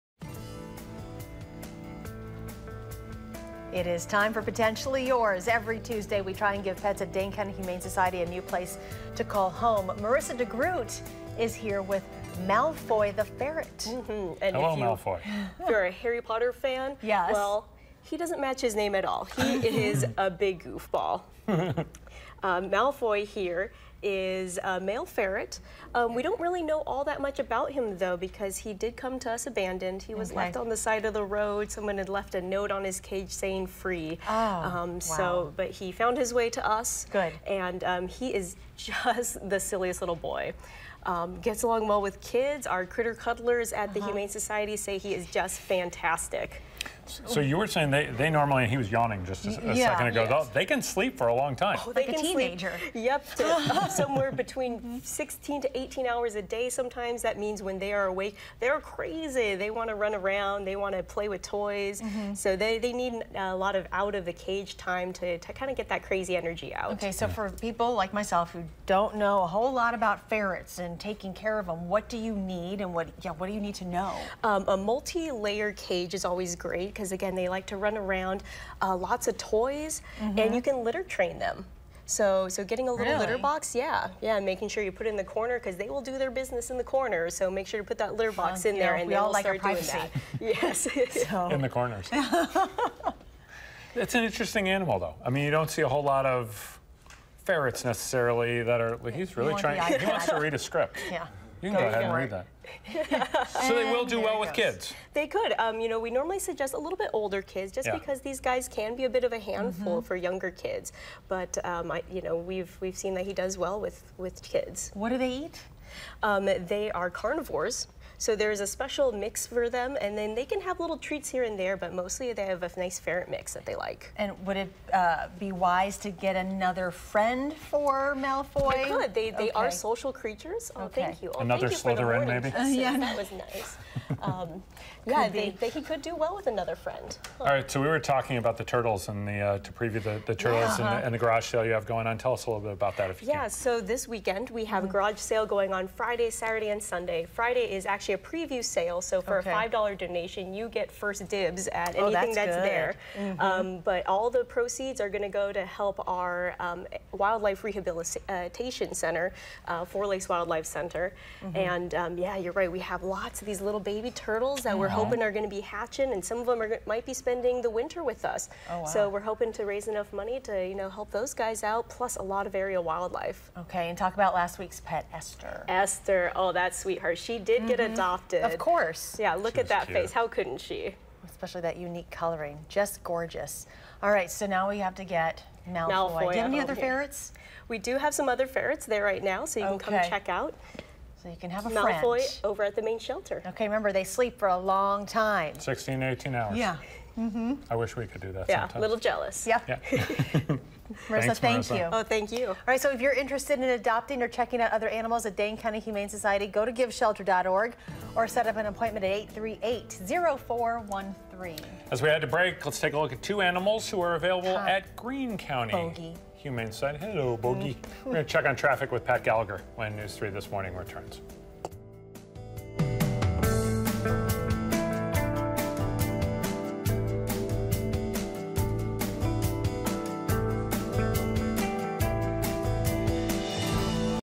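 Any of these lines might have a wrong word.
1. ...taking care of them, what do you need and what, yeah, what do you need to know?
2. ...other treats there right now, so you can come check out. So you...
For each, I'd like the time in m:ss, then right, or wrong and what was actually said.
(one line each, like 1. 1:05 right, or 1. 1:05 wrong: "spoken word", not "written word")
1. 1:10 right
2. 3:08 wrong: "ferrets", not "treats".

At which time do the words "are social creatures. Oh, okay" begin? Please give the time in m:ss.
2:09.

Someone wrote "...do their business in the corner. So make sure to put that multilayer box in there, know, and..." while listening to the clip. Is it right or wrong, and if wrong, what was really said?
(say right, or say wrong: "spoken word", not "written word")
wrong: "litter", not "multilayer".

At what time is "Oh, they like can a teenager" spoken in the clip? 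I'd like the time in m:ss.
0:51.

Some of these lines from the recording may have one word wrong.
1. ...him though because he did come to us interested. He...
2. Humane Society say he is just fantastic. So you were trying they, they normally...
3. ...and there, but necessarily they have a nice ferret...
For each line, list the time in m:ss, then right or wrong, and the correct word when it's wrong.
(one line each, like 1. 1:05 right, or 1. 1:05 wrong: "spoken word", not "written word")
1. 0:27 wrong: "abandoned", not "interested"
2. 0:44 wrong: "saying", not "trying"
3. 2:01 wrong: "mostly", not "necessarily".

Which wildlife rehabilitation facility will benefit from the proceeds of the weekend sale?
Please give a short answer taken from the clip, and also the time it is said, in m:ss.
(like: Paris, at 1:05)
Four Lakes Wildlife Center, at 2:39.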